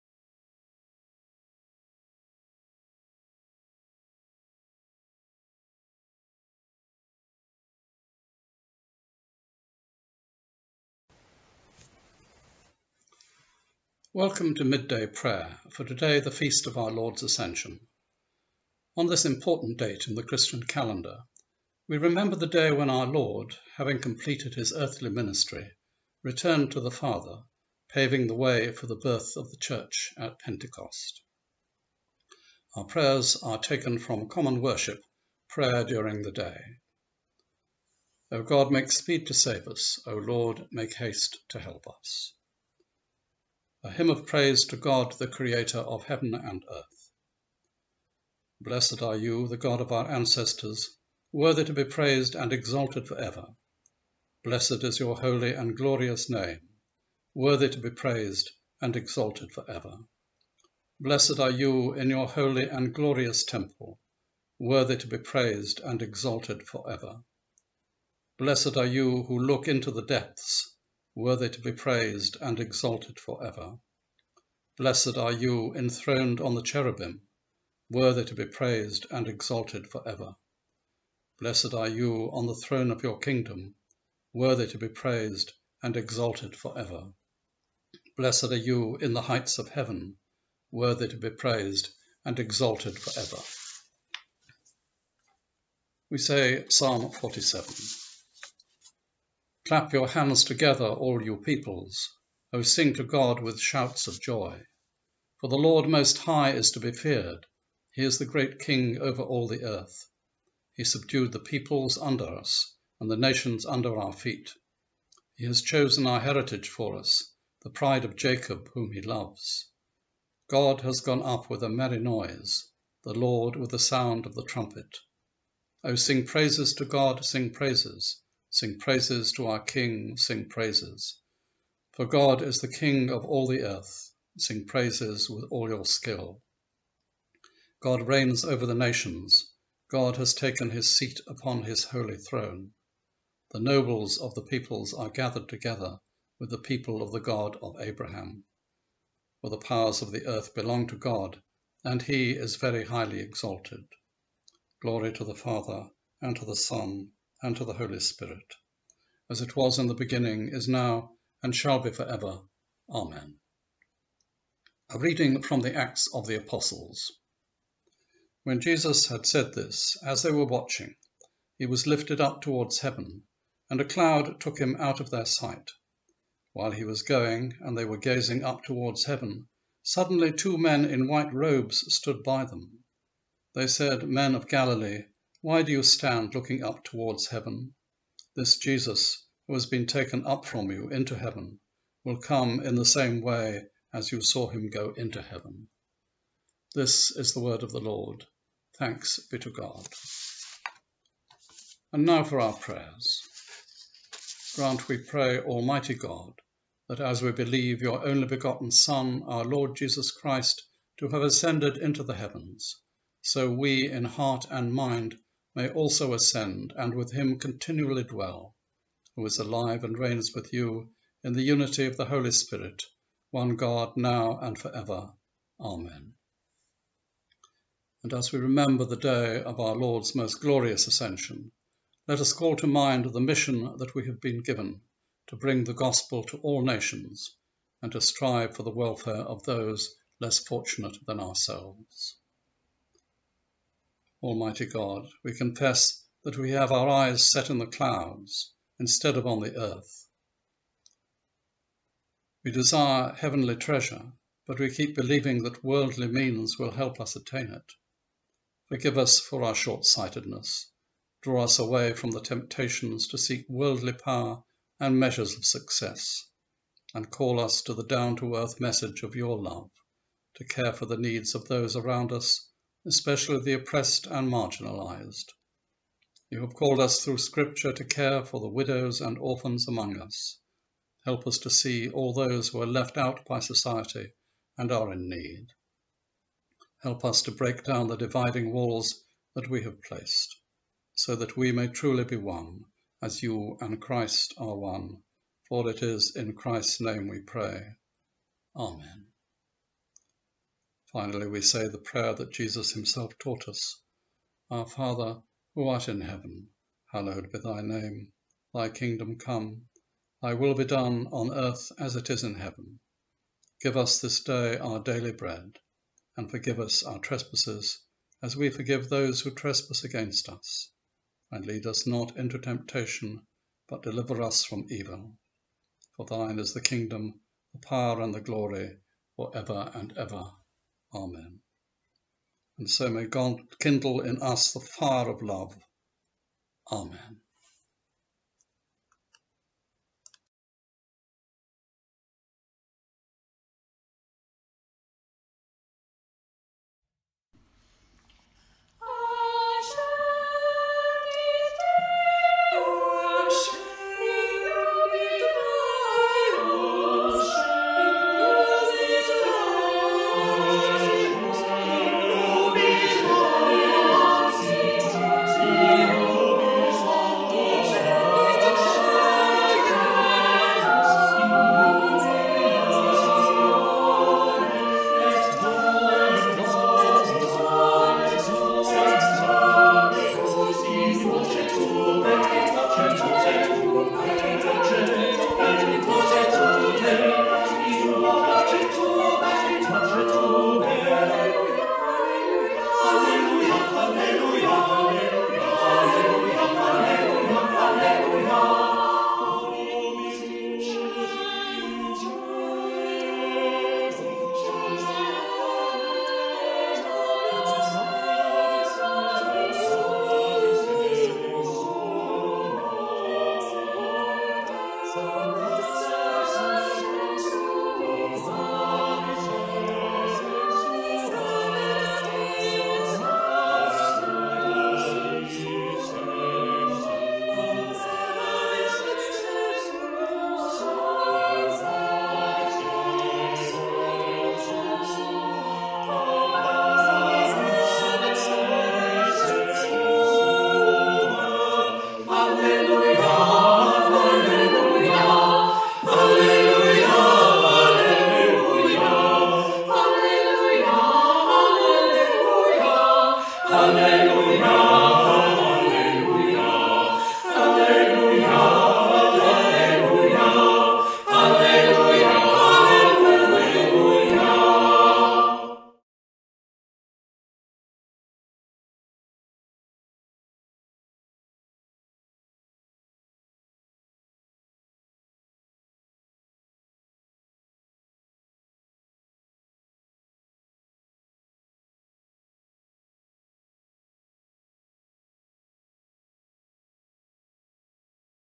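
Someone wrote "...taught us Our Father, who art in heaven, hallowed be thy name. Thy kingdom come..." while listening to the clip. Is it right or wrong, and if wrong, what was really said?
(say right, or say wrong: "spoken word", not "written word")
right.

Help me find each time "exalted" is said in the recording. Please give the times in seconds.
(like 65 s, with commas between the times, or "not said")
52 s, 58 s, 66 s, 72 s, 79 s, 85 s, 92 s, 153 s.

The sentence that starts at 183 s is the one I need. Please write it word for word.
They said, Men of Galilee, why do you stand looking up towards heaven?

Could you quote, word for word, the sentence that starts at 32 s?
Our prayers are taken from common worship, prayer during the day.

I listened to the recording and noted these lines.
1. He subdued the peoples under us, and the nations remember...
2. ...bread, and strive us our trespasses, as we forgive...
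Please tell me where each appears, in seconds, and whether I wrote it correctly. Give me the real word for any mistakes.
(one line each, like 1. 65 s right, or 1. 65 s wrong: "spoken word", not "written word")
1. 110 s wrong: "under", not "remember"
2. 315 s wrong: "forgive", not "strive".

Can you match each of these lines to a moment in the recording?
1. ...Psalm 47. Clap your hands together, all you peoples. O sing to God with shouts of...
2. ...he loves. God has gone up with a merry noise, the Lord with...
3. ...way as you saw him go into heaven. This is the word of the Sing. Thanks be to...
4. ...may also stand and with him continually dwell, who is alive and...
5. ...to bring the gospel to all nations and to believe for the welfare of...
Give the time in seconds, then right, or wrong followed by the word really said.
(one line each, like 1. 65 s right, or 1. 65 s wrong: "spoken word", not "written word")
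1. 96 s right
2. 118 s right
3. 193 s wrong: "Lord", not "Sing"
4. 215 s wrong: "ascend", not "stand"
5. 235 s wrong: "strive", not "believe".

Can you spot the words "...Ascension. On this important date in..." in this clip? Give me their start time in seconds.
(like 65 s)
17 s.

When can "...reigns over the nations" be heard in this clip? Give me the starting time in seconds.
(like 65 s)
138 s.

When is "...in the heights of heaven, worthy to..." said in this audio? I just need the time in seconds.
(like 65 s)
88 s.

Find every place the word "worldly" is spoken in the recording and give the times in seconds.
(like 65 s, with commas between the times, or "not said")
255 s, 263 s.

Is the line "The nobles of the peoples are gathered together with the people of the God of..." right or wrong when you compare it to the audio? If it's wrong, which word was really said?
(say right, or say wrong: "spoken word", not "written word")
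right.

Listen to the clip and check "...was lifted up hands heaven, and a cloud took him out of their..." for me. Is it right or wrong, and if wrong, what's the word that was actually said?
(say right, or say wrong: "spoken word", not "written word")
wrong: "towards", not "hands".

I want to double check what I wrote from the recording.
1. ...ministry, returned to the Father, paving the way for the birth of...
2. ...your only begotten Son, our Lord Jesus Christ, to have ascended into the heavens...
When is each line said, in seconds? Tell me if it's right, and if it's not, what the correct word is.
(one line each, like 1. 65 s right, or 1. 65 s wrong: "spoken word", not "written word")
1. 25 s right
2. 207 s right.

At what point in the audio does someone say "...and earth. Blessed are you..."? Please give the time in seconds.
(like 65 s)
46 s.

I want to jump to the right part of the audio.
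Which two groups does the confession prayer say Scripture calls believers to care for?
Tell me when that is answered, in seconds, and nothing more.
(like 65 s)
278 s.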